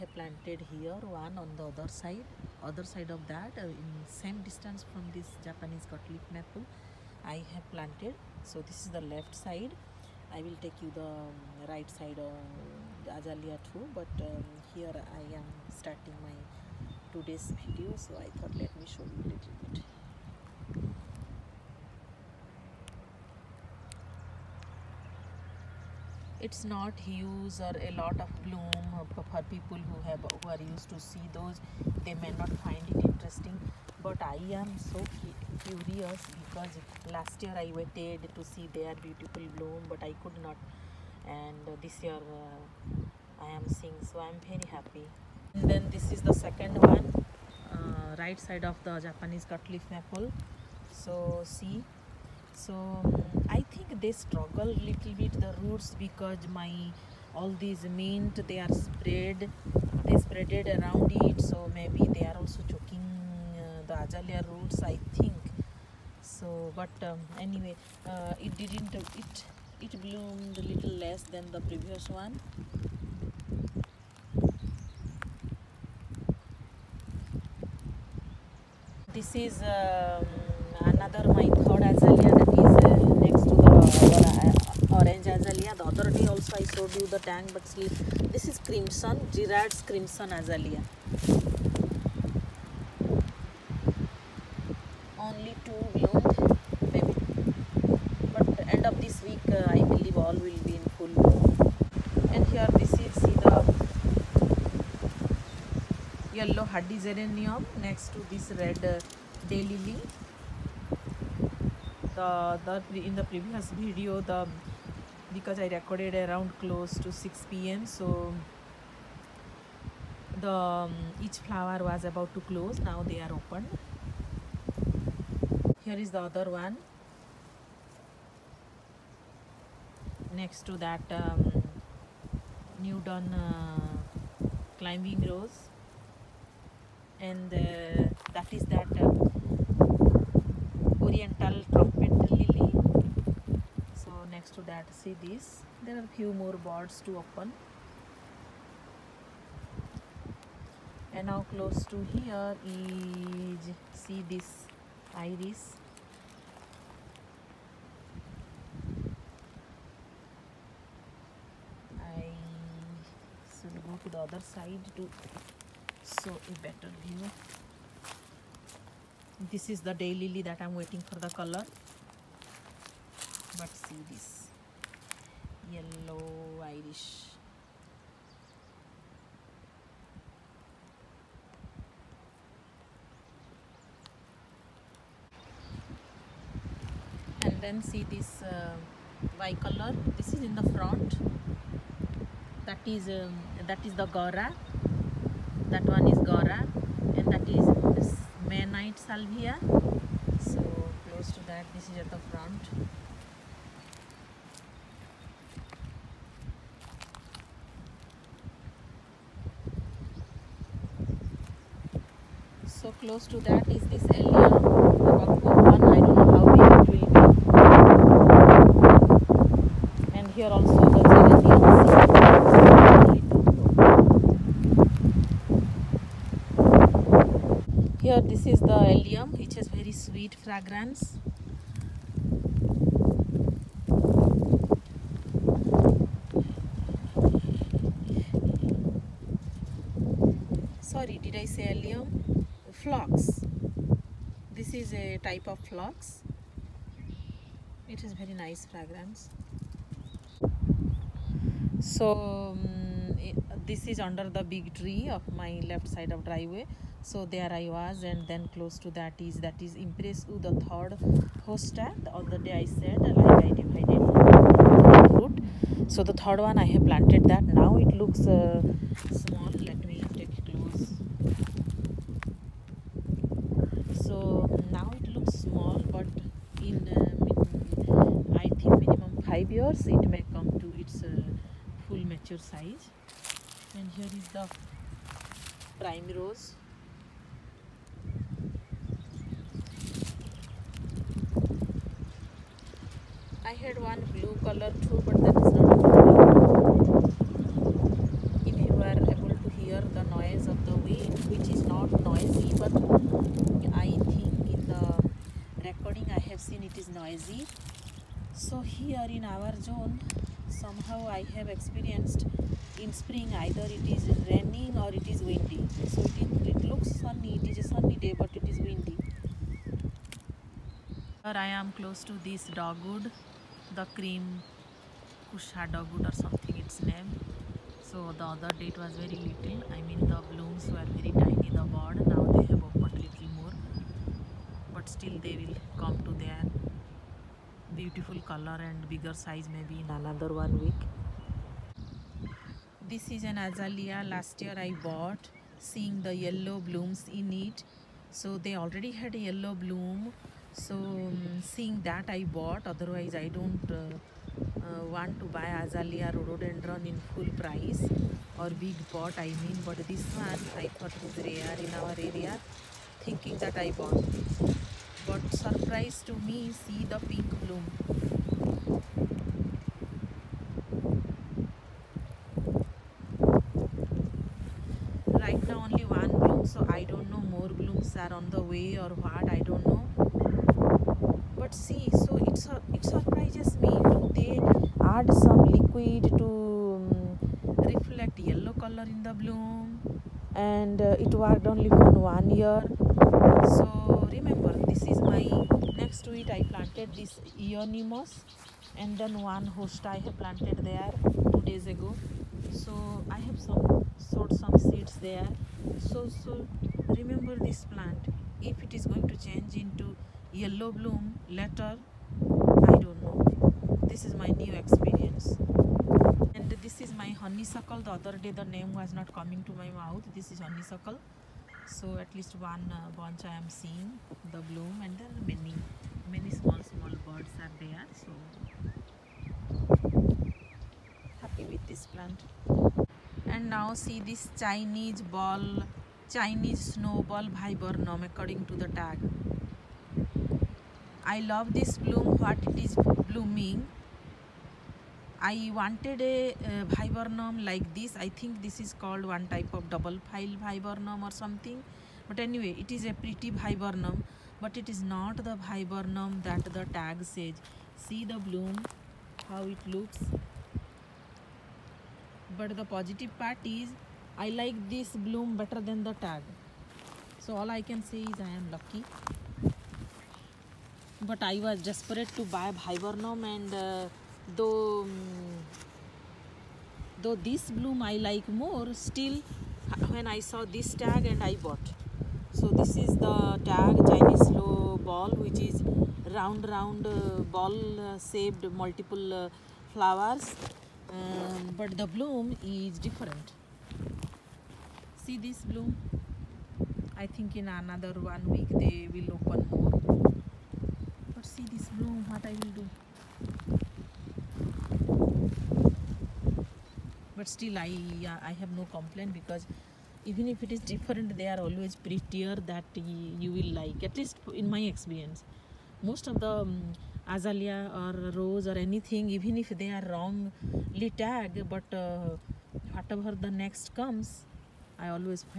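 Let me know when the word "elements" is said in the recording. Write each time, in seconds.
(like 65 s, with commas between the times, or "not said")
not said.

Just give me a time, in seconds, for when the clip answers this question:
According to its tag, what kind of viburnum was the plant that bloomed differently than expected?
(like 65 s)
436 s.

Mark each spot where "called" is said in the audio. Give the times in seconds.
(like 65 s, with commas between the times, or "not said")
448 s.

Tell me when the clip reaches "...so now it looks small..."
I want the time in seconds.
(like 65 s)
274 s.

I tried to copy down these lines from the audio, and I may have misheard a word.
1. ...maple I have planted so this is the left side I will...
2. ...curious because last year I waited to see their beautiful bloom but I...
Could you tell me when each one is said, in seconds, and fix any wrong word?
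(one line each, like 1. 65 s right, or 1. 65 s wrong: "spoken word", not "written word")
1. 6 s right
2. 35 s right.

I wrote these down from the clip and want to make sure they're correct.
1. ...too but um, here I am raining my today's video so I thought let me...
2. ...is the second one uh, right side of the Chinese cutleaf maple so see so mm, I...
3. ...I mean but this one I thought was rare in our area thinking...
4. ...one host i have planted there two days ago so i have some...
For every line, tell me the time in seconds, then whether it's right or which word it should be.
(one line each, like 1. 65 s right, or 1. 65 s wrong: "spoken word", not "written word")
1. 13 s wrong: "starting", not "raining"
2. 46 s wrong: "Japanese", not "Chinese"
3. 359 s right
4. 399 s right.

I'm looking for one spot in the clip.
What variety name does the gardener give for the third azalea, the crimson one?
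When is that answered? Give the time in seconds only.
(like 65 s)
89 s.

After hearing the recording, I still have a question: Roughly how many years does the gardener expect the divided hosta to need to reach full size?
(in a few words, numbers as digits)
5.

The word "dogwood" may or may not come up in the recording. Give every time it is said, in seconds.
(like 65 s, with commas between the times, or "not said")
322 s.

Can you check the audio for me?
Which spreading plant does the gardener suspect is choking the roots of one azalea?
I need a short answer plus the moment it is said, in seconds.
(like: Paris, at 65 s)
mint, at 57 s.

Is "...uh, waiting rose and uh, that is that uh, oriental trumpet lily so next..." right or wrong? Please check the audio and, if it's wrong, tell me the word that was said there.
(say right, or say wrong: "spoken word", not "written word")
wrong: "climbing", not "waiting".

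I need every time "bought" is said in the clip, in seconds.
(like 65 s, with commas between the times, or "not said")
344 s, 352 s, 363 s, 481 s.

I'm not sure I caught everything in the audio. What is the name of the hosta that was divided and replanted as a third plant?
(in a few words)
Empress Wu.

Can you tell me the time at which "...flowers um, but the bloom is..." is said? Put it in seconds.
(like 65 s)
489 s.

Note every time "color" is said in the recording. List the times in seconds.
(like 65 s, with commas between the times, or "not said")
171 s, 189 s, 294 s, 338 s, 388 s.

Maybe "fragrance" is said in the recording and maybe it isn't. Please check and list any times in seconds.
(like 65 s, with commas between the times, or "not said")
230 s, 248 s.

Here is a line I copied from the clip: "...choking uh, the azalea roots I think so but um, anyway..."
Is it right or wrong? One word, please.
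right.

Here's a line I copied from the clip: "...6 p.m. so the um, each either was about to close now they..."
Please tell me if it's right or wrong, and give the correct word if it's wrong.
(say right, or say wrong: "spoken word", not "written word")
wrong: "flower", not "either".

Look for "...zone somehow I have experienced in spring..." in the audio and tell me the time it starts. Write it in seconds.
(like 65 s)
309 s.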